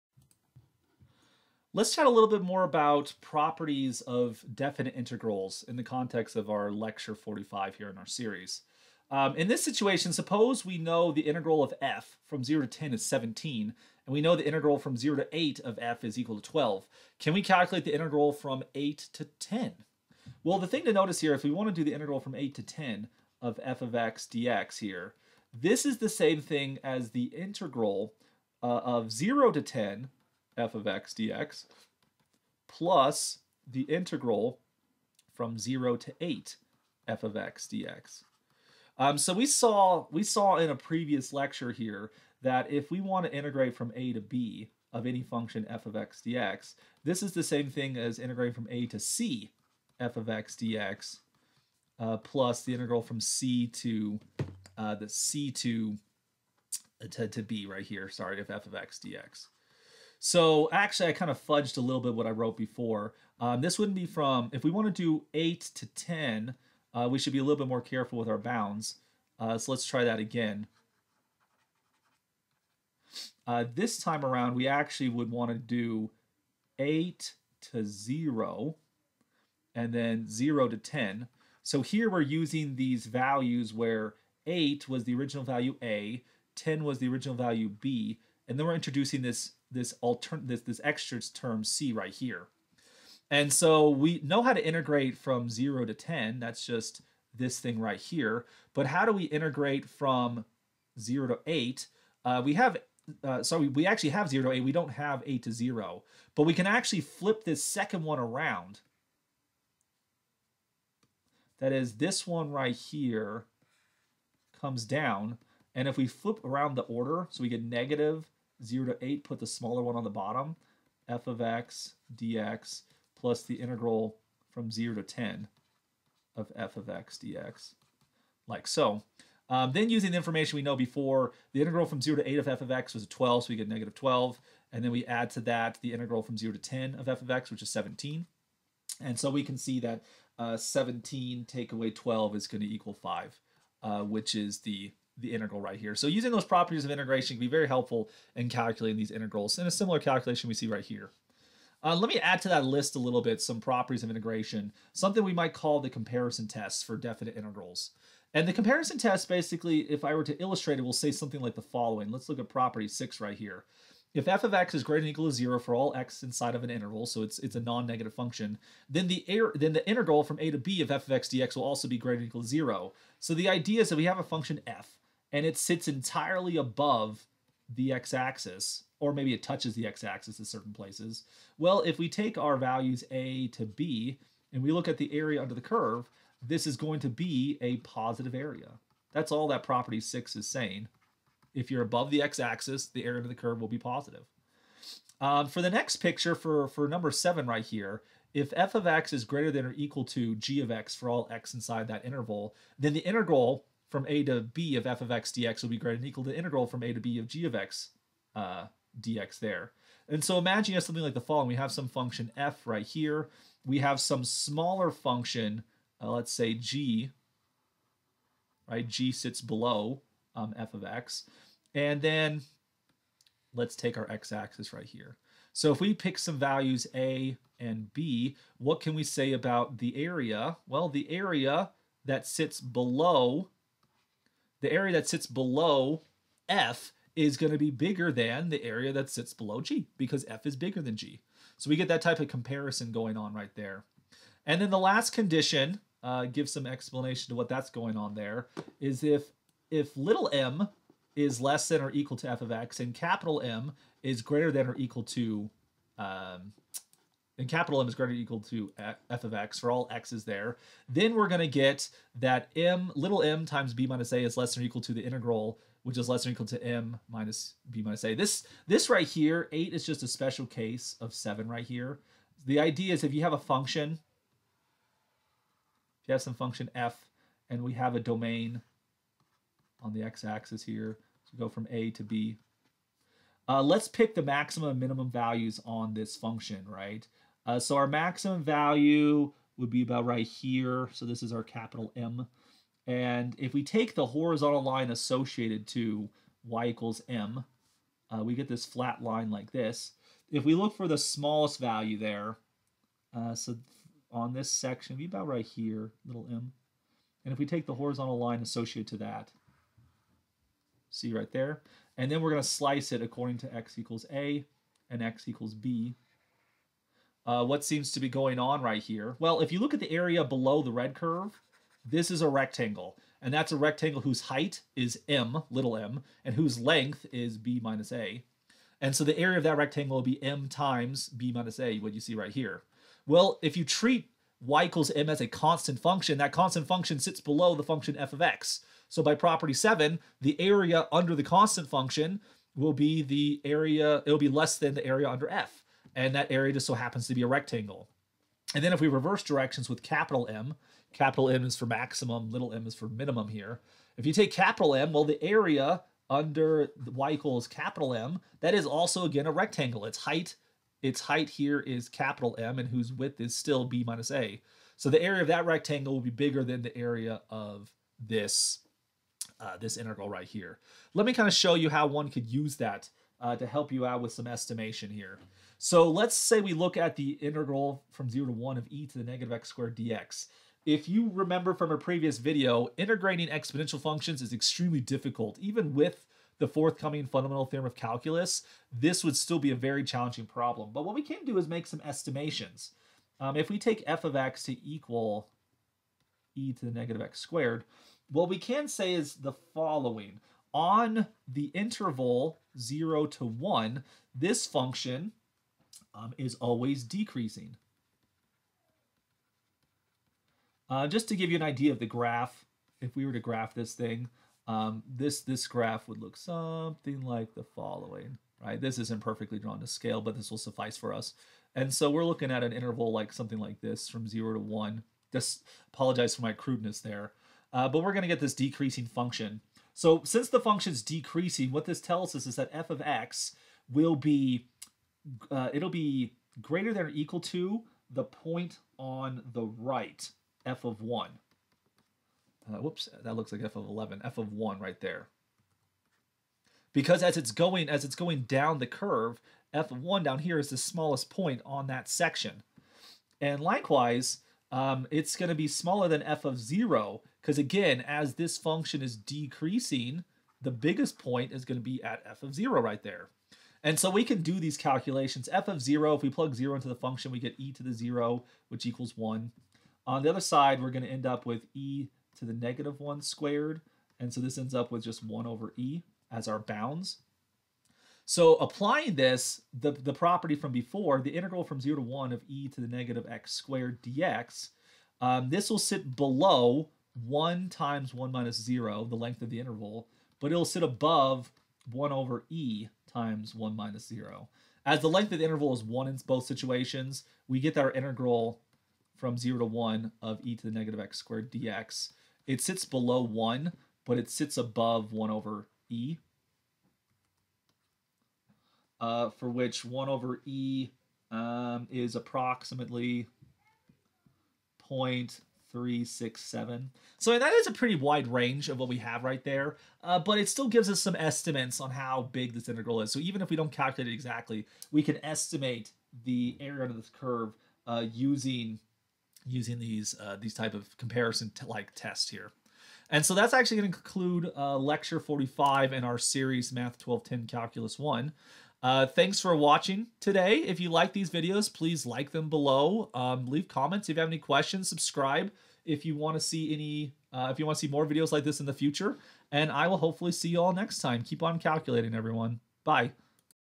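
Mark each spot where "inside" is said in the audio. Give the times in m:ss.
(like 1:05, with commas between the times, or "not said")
2:46, 3:21.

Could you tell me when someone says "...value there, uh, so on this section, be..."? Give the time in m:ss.
5:01.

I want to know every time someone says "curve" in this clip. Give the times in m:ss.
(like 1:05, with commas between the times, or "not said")
3:05, 3:13, 5:20, 7:28, 8:46.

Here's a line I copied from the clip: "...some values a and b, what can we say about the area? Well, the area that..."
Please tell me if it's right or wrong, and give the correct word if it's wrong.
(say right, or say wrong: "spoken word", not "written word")
right.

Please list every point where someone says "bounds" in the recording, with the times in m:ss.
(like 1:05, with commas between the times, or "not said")
1:08, 7:56.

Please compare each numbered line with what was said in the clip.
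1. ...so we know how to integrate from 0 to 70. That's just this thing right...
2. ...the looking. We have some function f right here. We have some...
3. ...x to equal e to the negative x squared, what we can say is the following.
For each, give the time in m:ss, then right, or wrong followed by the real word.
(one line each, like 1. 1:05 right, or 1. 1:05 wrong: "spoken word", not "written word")
1. 1:33 wrong: "10", not "70"
2. 3:31 wrong: "following", not "looking"
3. 6:34 right.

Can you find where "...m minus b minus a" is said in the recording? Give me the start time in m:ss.
4:26.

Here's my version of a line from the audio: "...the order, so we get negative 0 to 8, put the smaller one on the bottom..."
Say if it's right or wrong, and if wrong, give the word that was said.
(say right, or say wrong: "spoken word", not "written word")
right.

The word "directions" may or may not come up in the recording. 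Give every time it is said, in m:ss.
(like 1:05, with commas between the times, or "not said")
5:49.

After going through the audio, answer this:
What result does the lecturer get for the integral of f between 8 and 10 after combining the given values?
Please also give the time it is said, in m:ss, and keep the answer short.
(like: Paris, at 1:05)
5, at 2:22.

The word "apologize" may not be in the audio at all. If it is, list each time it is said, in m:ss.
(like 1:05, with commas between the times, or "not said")
7:05.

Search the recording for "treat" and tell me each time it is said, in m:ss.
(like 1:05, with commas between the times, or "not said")
5:33.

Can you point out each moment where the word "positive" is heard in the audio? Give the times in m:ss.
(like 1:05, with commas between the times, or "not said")
3:07, 3:13.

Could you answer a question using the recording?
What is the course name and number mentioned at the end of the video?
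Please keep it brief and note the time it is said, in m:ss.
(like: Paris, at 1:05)
Math 1210 Calculus 1, at 8:56.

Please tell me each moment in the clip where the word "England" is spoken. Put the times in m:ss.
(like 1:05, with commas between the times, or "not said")
not said.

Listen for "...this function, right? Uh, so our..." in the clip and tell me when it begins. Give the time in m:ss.
4:45.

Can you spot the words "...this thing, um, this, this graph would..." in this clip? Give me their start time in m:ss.
6:53.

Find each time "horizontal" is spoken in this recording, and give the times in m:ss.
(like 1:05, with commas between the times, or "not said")
4:54, 5:07.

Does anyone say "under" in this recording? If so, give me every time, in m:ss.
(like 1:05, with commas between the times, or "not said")
3:05, 3:13, 5:40, 5:45, 5:56, 8:46.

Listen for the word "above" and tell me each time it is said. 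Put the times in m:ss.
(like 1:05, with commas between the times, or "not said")
2:56, 3:11, 8:10, 8:24.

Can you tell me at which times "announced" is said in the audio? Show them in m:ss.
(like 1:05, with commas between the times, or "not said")
not said.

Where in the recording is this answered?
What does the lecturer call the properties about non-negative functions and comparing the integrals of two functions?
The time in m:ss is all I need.
2:35.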